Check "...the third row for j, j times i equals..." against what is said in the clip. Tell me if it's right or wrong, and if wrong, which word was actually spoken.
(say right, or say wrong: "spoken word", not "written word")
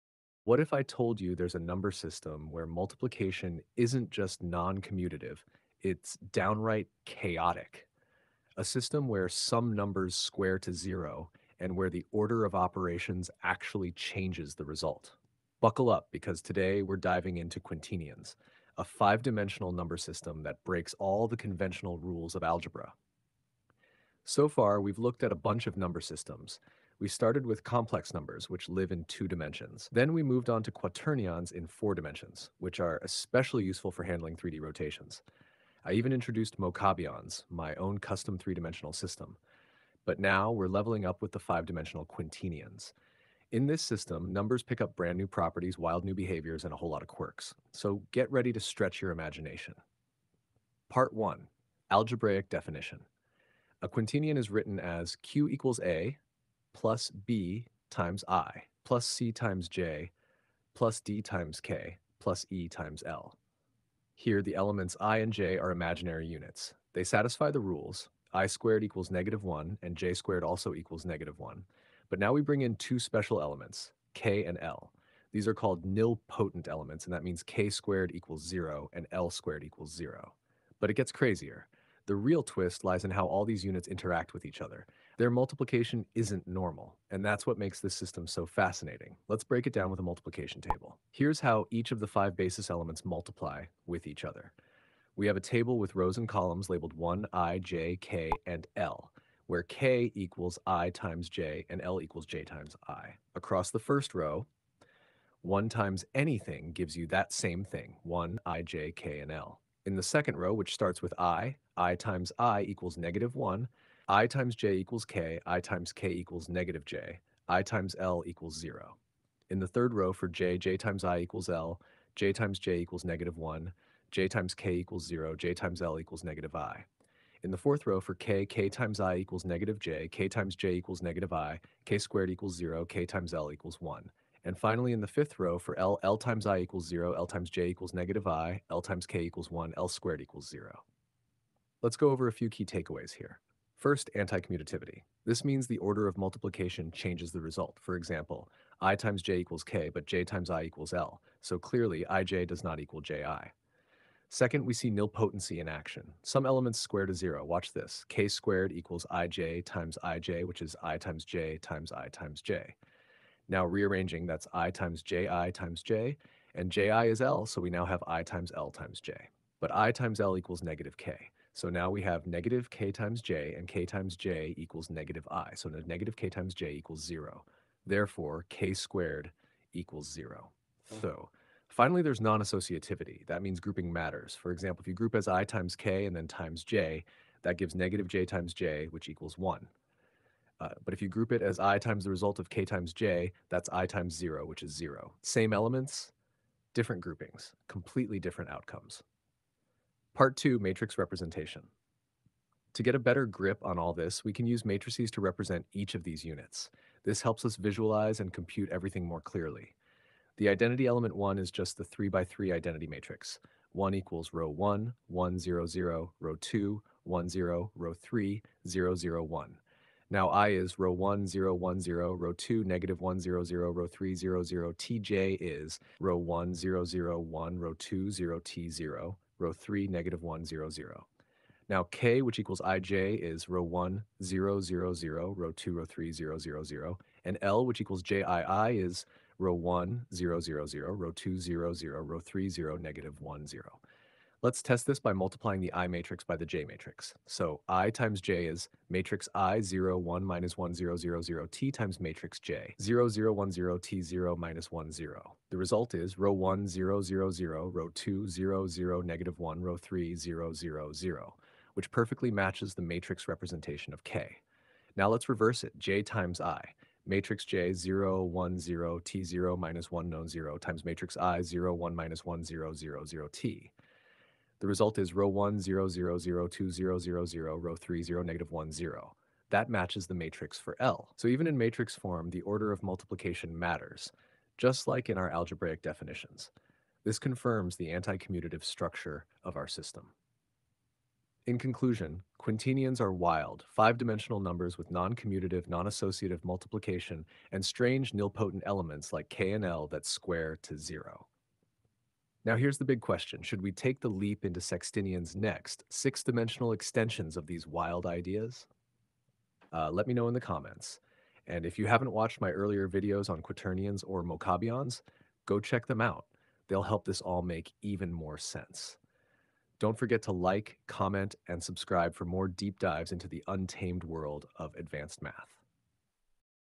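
right.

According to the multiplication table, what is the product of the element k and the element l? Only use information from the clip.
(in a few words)
1.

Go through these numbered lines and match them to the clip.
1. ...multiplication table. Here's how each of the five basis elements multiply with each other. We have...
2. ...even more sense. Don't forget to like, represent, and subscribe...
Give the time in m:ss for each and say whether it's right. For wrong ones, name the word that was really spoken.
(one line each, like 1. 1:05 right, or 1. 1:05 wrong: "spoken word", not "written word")
1. 1:30 right
2. 5:17 wrong: "comment", not "represent".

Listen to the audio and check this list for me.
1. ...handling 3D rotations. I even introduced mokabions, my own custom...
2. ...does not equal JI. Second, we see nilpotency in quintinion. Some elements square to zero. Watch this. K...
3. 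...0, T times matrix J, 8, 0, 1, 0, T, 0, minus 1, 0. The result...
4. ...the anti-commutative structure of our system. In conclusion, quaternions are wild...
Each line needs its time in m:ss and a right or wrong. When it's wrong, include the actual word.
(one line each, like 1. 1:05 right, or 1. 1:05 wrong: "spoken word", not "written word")
1. 0:34 right
2. 2:32 wrong: "action", not "quintinion"
3. 4:11 wrong: "0", not "8"
4. 4:47 right.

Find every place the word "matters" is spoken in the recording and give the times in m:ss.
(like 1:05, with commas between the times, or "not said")
3:03, 4:43.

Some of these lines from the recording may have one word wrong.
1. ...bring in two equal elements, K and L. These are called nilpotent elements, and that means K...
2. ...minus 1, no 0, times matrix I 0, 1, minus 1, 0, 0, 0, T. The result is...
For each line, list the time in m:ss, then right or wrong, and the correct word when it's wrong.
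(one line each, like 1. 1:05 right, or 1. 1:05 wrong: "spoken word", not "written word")
1. 1:12 wrong: "special", not "equal"
2. 4:29 right.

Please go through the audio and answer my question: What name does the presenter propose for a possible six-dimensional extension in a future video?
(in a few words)
Sextinions.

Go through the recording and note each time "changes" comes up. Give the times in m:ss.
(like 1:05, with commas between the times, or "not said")
0:13, 2:26.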